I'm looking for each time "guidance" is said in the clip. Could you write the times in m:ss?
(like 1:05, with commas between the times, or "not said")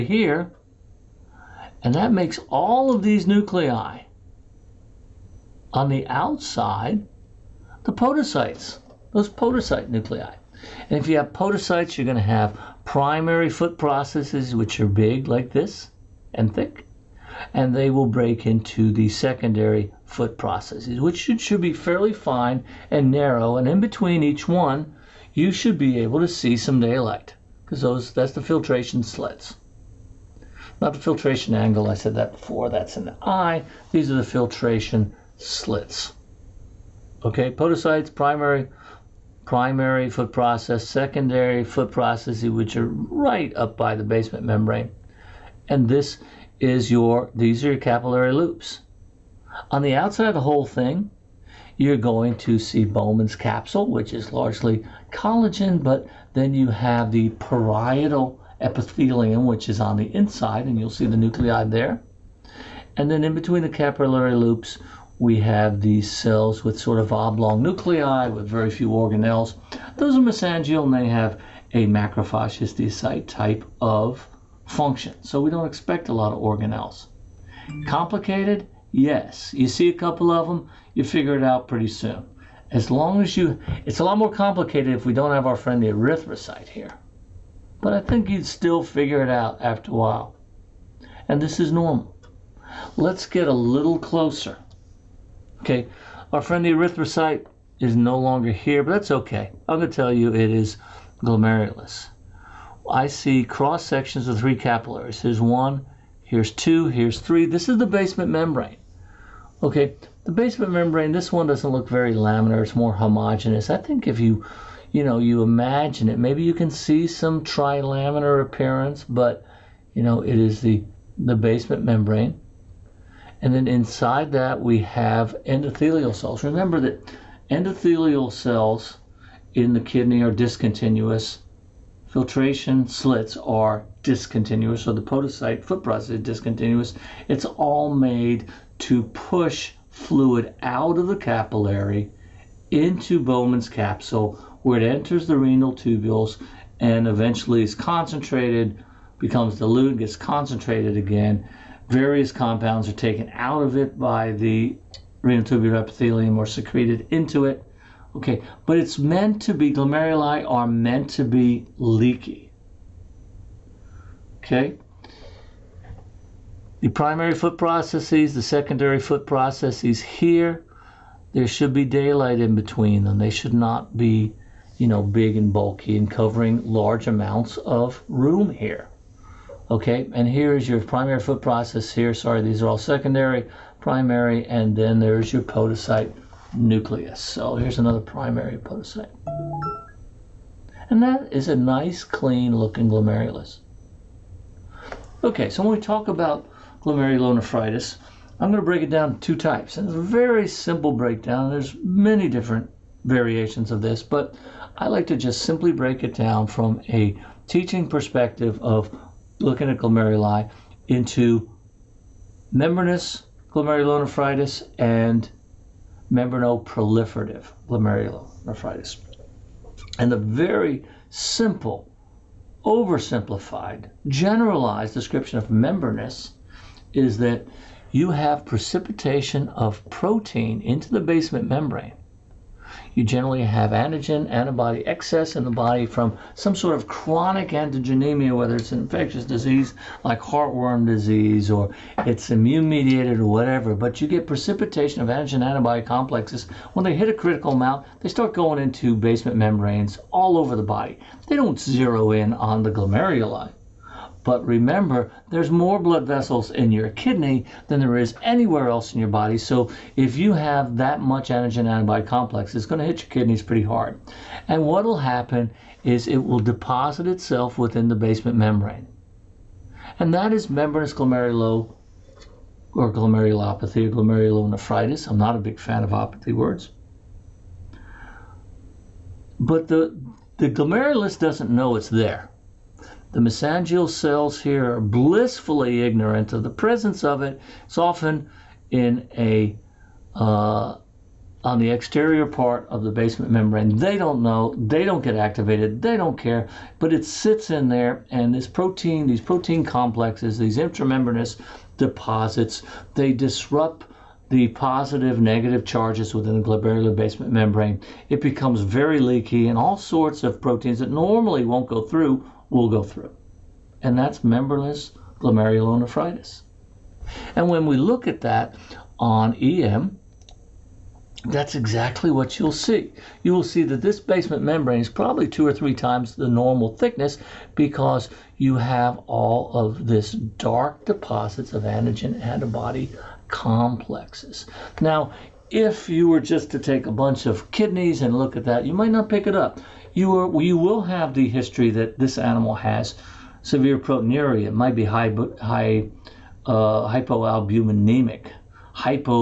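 not said.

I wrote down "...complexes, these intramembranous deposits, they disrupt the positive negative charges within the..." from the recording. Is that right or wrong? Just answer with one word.
right.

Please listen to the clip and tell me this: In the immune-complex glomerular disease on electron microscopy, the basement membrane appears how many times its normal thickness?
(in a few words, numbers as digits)
2 or 3 times.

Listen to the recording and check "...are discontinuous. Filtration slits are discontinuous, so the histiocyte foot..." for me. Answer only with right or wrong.
wrong.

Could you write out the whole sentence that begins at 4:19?
So if you have that much antigen antibody complex, it's going to hit your kidneys pretty hard.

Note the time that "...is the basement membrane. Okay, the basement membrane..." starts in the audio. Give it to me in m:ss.
1:47.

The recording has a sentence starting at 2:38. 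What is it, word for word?
Okay, but it's meant to be, glomeruli are meant to be leaky.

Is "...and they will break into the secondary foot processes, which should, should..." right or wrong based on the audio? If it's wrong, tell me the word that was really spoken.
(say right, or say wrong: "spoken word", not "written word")
right.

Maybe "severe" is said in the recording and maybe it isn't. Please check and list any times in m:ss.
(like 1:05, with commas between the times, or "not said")
5:43.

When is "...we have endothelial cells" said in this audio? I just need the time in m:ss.
2:04.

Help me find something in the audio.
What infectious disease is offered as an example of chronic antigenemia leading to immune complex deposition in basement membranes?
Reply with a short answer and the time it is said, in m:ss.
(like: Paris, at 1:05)
heartworm disease, at 4:00.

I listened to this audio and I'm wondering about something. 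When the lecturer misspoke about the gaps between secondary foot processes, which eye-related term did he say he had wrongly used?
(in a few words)
filtration angle.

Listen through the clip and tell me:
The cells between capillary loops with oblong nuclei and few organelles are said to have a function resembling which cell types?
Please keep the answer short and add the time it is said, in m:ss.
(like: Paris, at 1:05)
macrophage histiocyte, at 1:11.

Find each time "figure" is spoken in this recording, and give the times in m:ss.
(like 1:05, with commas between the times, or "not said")
1:21, 1:28.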